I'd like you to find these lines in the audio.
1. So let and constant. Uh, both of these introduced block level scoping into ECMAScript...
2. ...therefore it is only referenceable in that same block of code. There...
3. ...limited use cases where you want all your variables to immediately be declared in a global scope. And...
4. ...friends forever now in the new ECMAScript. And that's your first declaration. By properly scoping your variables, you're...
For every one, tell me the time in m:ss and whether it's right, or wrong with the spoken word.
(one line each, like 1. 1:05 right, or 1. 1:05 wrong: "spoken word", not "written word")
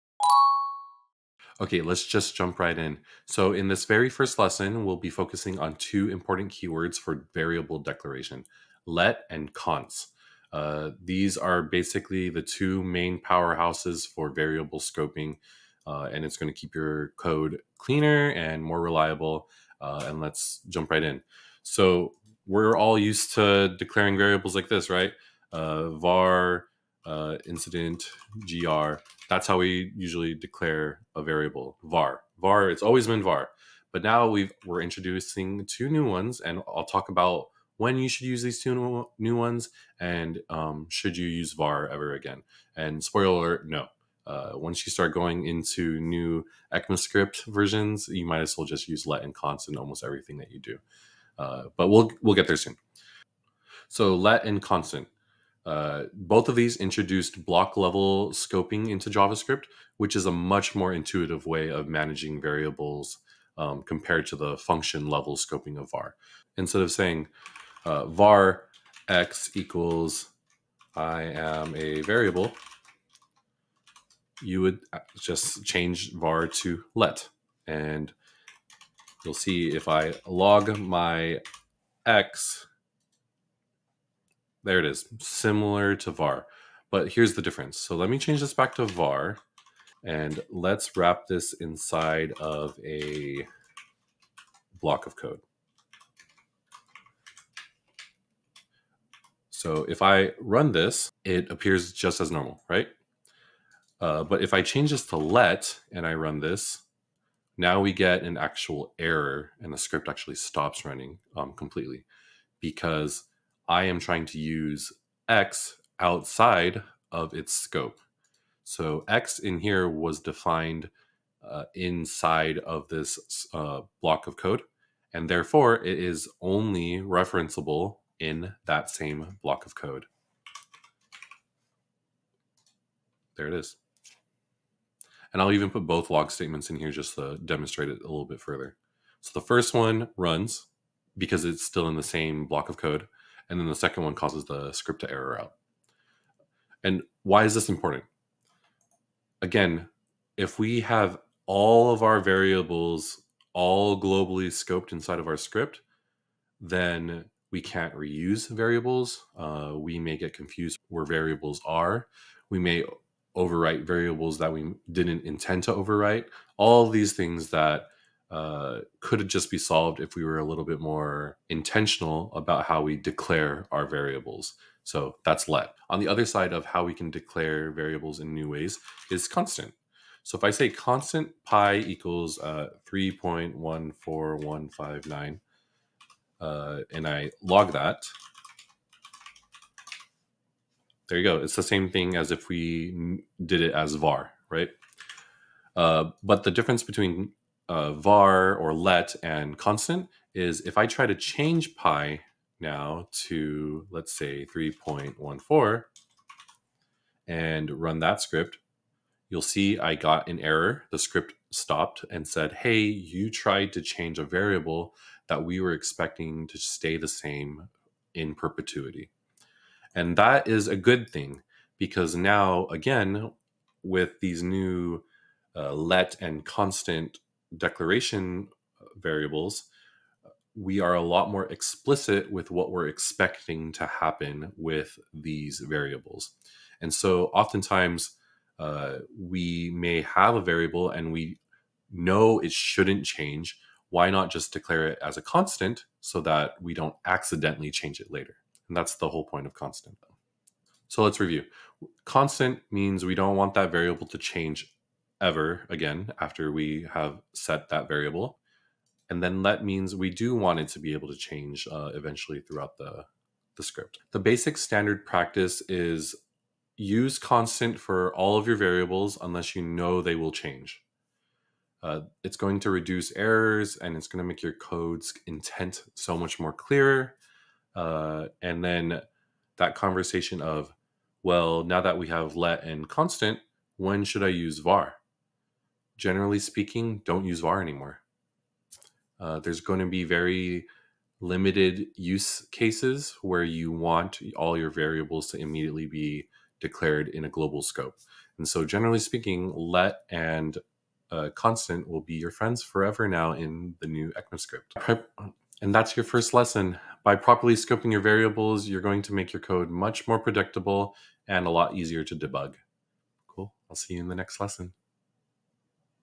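1. 0:53 wrong: "JavaScript", not "ECMAScript"
2. 2:05 right
3. 4:51 right
4. 5:02 wrong: "lesson", not "declaration".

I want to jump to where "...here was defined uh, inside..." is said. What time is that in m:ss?
1:59.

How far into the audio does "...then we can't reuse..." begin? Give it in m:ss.
2:36.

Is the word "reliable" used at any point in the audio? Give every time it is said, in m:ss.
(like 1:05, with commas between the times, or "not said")
0:18.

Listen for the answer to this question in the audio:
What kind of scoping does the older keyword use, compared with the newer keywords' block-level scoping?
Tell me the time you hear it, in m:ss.
1:04.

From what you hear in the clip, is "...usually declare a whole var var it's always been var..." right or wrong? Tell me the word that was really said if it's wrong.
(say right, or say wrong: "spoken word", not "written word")
wrong: "variable", not "whole".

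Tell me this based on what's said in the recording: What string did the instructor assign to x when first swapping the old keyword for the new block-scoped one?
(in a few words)
I am a variable.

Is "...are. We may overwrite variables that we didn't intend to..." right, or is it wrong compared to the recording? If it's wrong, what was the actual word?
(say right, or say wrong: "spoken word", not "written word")
right.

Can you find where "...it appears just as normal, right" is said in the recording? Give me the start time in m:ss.
1:41.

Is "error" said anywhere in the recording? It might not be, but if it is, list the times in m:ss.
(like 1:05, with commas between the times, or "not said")
1:48, 2:25, 3:30, 4:33.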